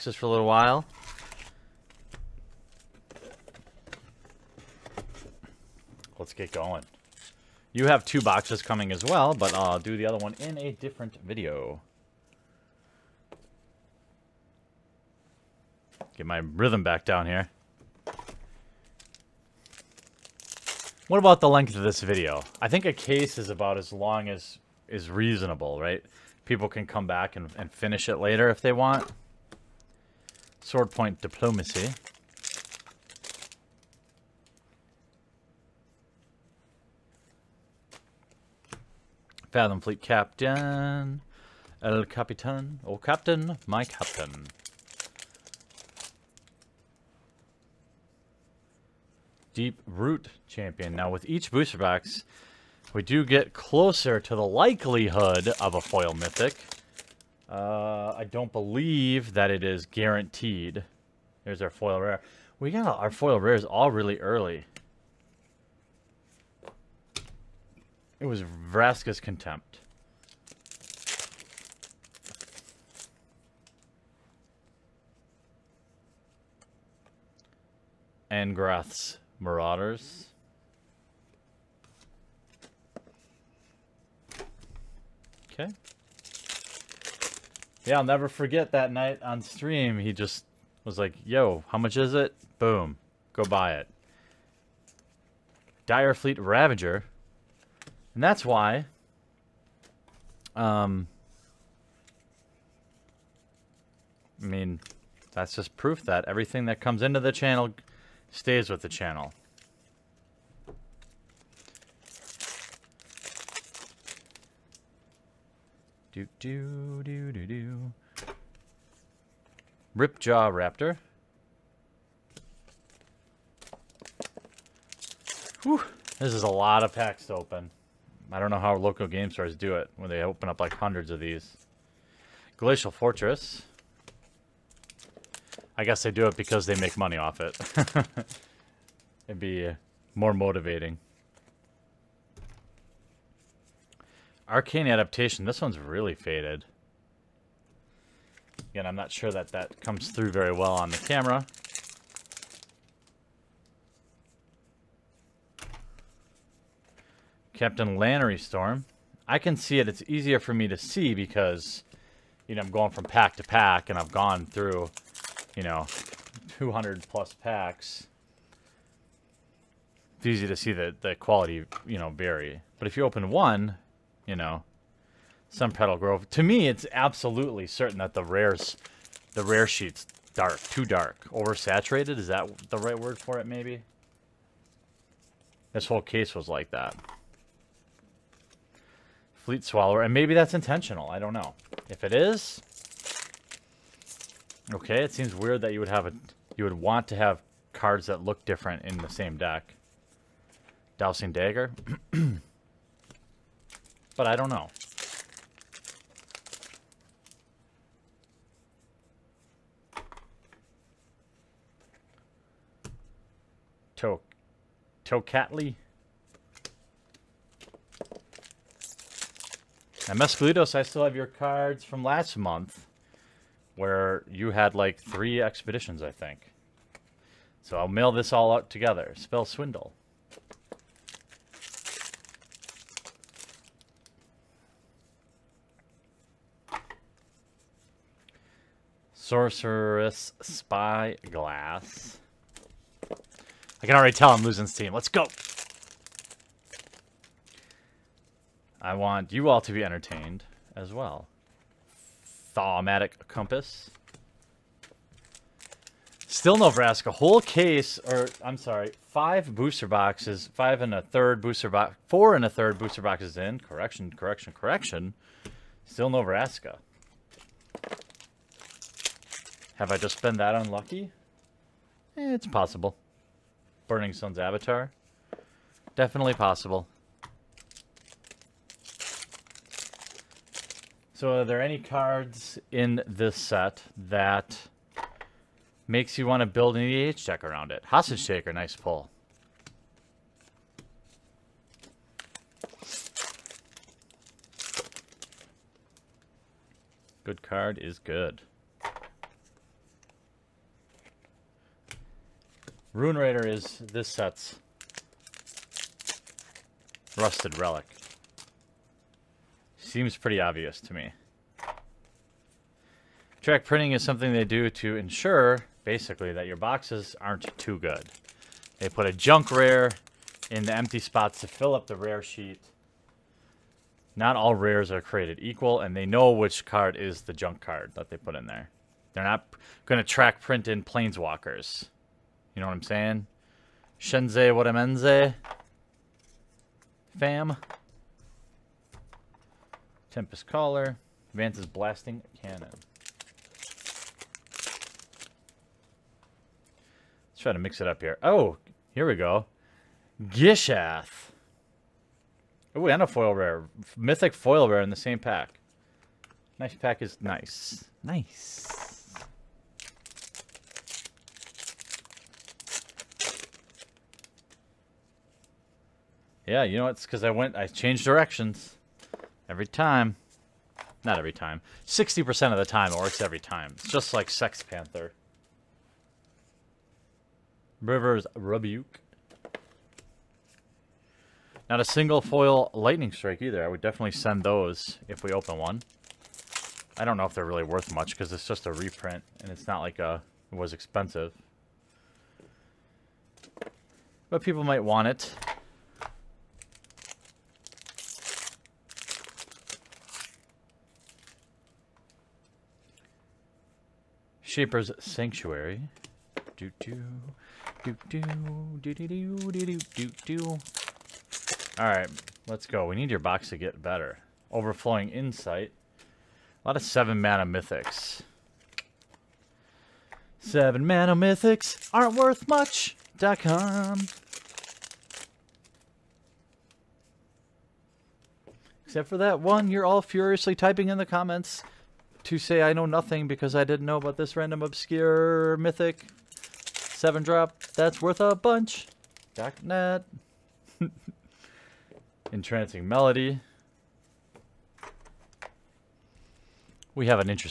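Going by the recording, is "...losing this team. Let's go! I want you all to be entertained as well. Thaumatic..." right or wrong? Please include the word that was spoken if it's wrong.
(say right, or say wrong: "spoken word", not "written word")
right.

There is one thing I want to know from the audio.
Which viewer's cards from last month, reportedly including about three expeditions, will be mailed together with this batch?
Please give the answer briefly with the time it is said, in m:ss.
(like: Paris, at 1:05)
Mescalitos, at 3:40.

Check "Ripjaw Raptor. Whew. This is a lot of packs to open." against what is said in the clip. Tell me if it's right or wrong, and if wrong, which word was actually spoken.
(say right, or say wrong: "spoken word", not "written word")
right.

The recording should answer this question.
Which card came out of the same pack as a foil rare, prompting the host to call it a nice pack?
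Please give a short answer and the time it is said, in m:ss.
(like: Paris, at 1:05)
Gishath, at 5:50.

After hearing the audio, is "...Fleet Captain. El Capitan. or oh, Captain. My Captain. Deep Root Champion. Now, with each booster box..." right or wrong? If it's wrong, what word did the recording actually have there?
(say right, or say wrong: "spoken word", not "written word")
right.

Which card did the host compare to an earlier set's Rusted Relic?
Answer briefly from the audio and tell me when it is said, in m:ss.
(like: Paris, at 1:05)
Ruin Raider, at 5:02.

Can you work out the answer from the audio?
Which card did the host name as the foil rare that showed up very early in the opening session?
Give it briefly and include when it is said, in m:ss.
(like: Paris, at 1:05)
Vraska's Contempt, at 1:08.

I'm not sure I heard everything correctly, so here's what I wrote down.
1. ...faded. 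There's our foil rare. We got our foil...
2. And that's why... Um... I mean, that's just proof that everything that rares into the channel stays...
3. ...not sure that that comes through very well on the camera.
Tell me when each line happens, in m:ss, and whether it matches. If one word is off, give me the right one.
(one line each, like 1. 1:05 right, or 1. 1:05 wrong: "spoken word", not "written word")
1. 0:59 wrong: "guaranteed", not "faded"
2. 1:38 wrong: "comes", not "rares"
3. 2:28 right.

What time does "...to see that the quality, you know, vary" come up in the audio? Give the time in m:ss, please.
2:50.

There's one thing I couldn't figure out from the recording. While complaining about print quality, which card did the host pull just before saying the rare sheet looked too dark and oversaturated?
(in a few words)
Captain Lannery Storm.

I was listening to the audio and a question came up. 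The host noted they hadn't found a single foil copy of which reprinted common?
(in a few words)
Lightning Strike.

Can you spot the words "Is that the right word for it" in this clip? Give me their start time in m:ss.
3:02.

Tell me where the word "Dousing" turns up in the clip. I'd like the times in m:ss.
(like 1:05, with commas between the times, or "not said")
3:20.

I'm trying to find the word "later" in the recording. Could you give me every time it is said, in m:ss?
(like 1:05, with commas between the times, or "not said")
0:28.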